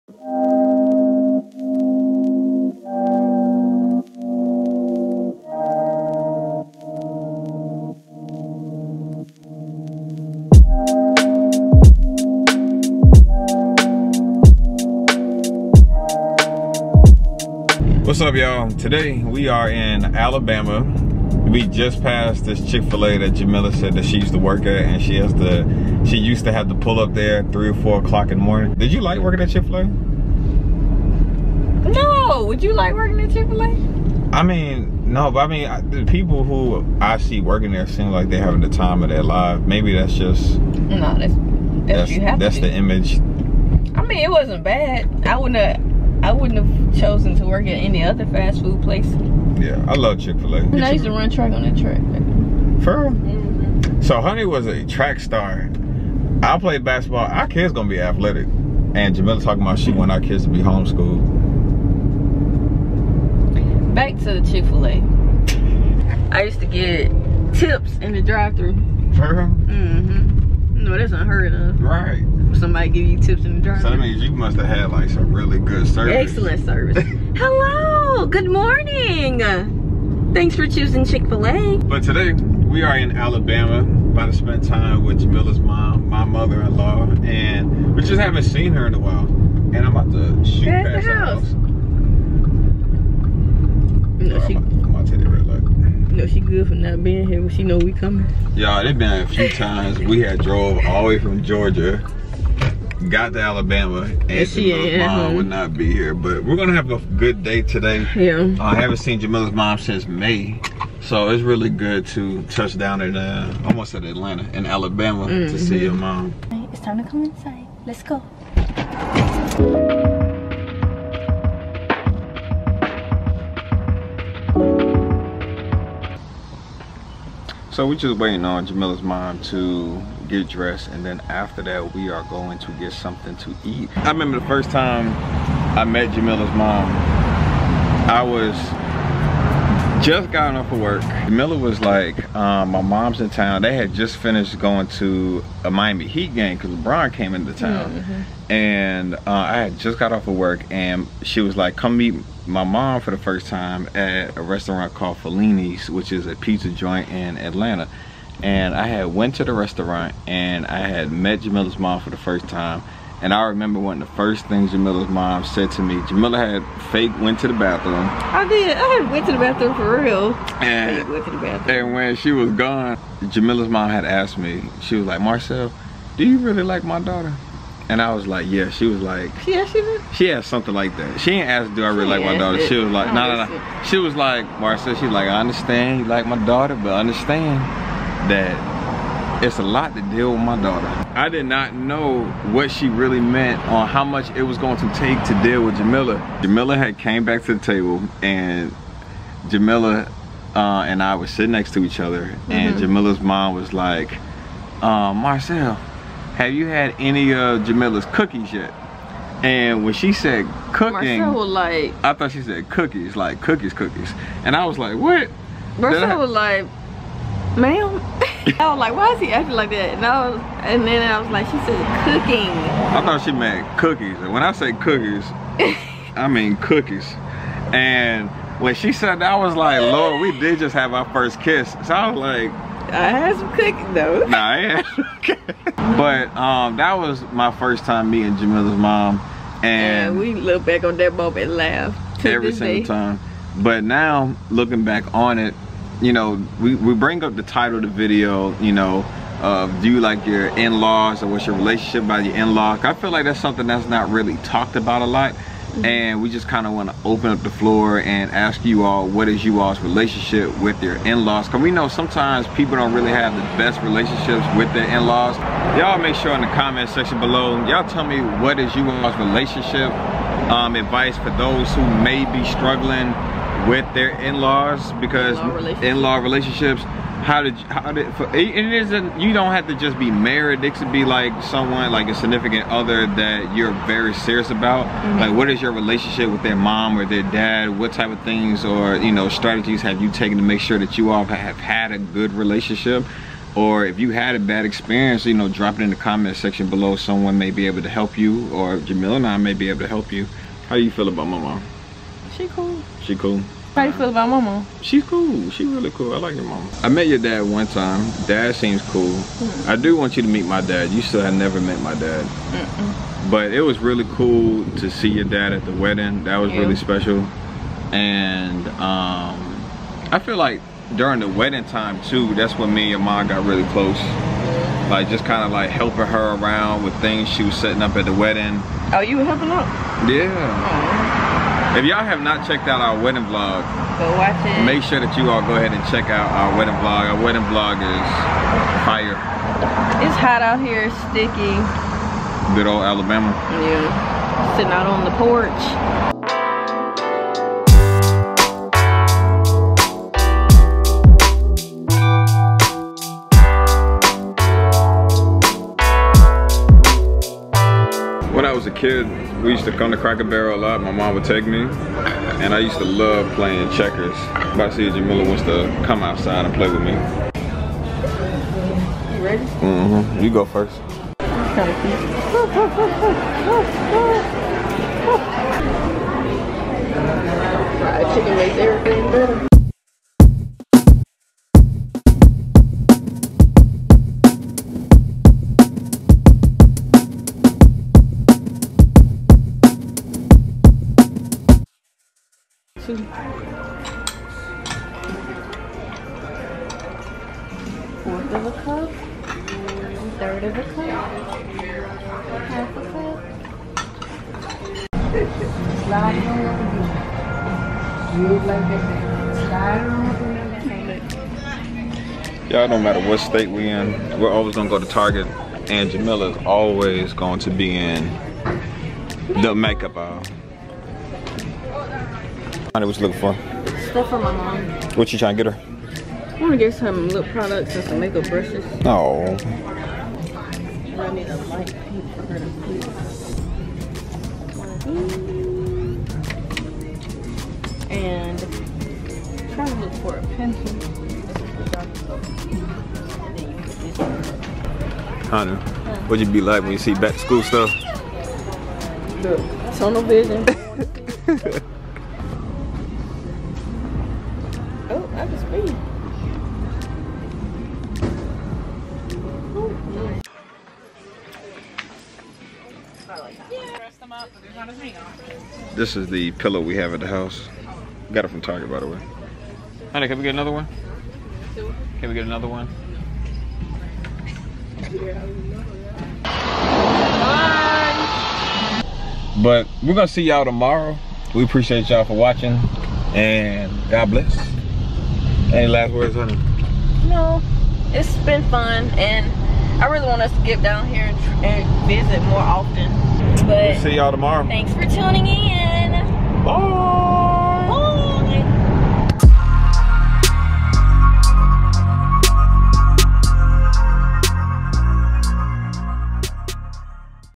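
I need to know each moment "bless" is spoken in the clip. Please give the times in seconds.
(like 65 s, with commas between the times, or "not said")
484 s.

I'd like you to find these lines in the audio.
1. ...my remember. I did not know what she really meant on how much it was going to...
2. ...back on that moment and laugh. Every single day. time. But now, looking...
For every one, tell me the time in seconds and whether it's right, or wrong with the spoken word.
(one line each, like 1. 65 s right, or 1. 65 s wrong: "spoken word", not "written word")
1. 190 s wrong: "daughter", not "remember"
2. 240 s right.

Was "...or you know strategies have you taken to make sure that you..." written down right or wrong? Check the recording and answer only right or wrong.
right.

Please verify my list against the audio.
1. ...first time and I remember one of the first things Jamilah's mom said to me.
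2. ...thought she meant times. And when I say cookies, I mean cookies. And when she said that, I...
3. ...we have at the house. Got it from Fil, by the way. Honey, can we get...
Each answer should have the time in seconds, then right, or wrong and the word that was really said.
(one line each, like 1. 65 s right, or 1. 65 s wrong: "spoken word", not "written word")
1. 162 s right
2. 223 s wrong: "cookies", not "times"
3. 466 s wrong: "Target", not "Fil".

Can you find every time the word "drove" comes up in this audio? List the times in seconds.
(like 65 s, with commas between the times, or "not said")
100 s.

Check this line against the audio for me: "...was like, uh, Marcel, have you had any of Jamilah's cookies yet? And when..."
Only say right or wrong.
right.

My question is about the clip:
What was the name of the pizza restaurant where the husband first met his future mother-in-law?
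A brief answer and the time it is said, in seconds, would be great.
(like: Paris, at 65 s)
Fellini's, at 155 s.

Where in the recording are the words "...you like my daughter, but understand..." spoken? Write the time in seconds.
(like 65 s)
185 s.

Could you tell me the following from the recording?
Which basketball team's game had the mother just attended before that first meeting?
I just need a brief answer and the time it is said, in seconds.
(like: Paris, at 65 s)
Miami Heat, at 145 s.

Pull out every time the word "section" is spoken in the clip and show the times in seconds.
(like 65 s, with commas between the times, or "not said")
266 s, 296 s.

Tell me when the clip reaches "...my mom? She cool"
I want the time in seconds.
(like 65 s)
301 s.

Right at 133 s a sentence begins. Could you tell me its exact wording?
I remember the first time I met Jamilah's mom, I was just gotten off of work.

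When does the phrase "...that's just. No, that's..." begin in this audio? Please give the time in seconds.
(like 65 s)
39 s.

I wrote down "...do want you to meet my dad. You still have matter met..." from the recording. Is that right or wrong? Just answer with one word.
wrong.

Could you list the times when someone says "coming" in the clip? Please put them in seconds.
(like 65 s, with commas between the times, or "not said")
97 s.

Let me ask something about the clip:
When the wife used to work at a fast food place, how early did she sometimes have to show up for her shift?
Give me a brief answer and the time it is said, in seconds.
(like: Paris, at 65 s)
3 or 4 in the morning, at 27 s.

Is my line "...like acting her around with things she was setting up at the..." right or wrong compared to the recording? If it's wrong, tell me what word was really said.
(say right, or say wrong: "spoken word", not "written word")
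wrong: "helping", not "acting".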